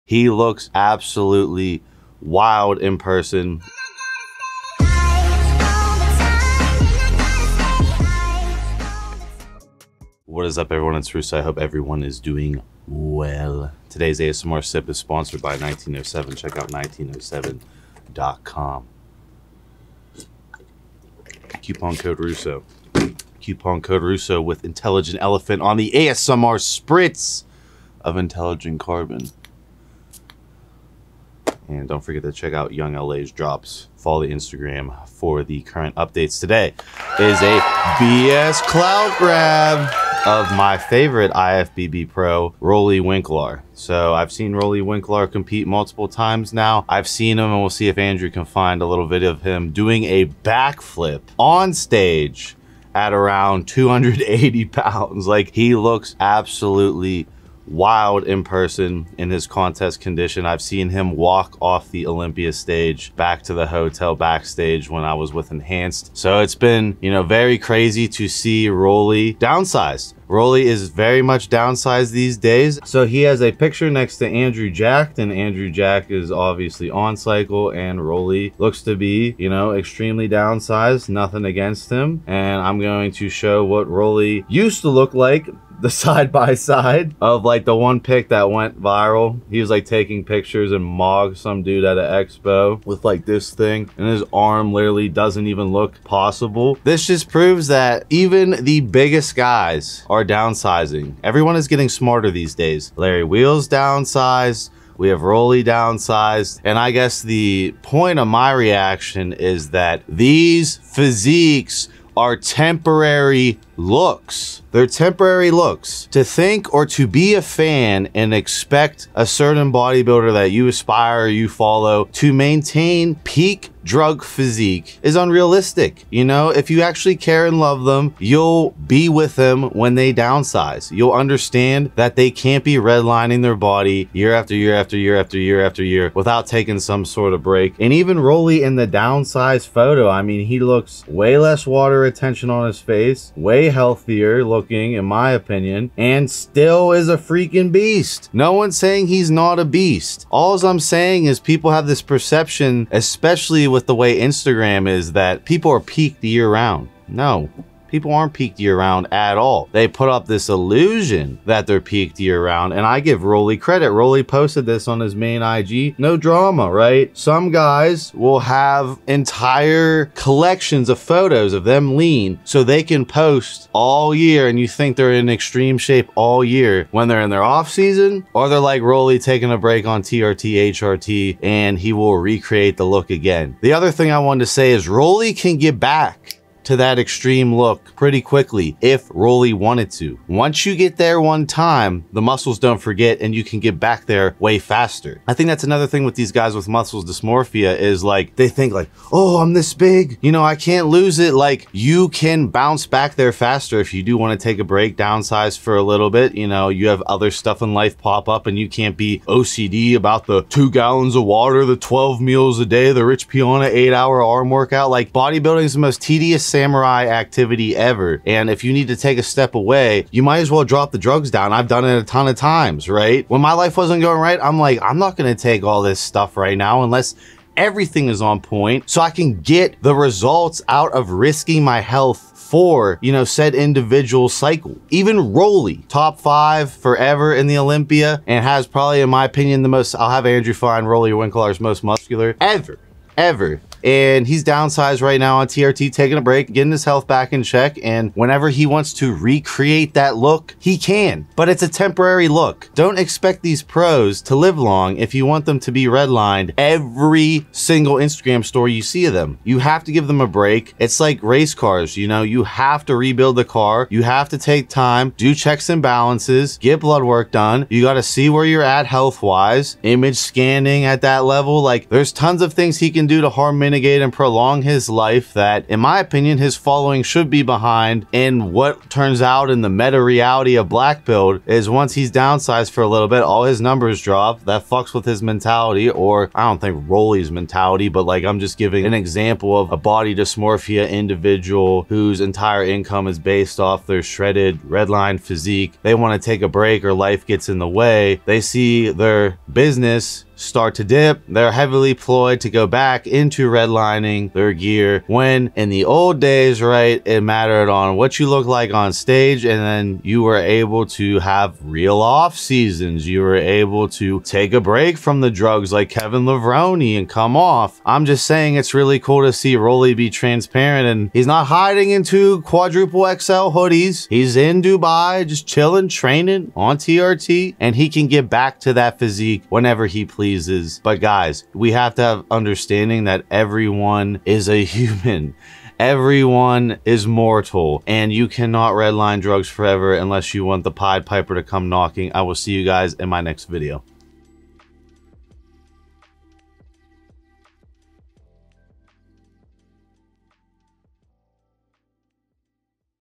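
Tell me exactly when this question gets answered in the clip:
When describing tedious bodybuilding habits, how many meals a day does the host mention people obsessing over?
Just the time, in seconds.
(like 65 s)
211 s.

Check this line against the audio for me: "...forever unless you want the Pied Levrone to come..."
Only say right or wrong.
wrong.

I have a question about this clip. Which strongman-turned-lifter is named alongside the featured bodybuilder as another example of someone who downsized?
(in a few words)
Larry Wheels.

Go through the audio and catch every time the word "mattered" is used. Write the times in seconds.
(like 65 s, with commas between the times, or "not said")
307 s.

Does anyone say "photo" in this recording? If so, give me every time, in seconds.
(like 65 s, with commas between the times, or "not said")
139 s, 170 s.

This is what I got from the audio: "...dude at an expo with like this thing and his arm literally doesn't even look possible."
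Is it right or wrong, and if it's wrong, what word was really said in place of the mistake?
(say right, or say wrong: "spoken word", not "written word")
right.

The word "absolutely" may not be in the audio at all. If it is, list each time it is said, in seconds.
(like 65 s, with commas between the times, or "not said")
0 s, 56 s.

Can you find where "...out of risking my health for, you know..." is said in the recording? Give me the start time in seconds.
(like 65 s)
230 s.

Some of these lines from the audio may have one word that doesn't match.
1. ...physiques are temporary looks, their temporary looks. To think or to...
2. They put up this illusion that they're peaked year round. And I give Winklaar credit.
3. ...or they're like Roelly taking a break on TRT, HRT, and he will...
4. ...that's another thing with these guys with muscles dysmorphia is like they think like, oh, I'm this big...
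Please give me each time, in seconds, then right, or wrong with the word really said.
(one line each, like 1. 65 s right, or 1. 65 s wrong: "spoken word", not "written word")
1. 110 s right
2. 159 s wrong: "Roelly", not "Winklaar"
3. 178 s right
4. 195 s right.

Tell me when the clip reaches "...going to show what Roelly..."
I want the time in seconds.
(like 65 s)
82 s.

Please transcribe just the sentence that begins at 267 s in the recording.
You got to see where you're at health wise, image scanning at that level.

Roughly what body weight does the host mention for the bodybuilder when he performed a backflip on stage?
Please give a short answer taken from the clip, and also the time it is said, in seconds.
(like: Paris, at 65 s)
280 pounds, at 53 s.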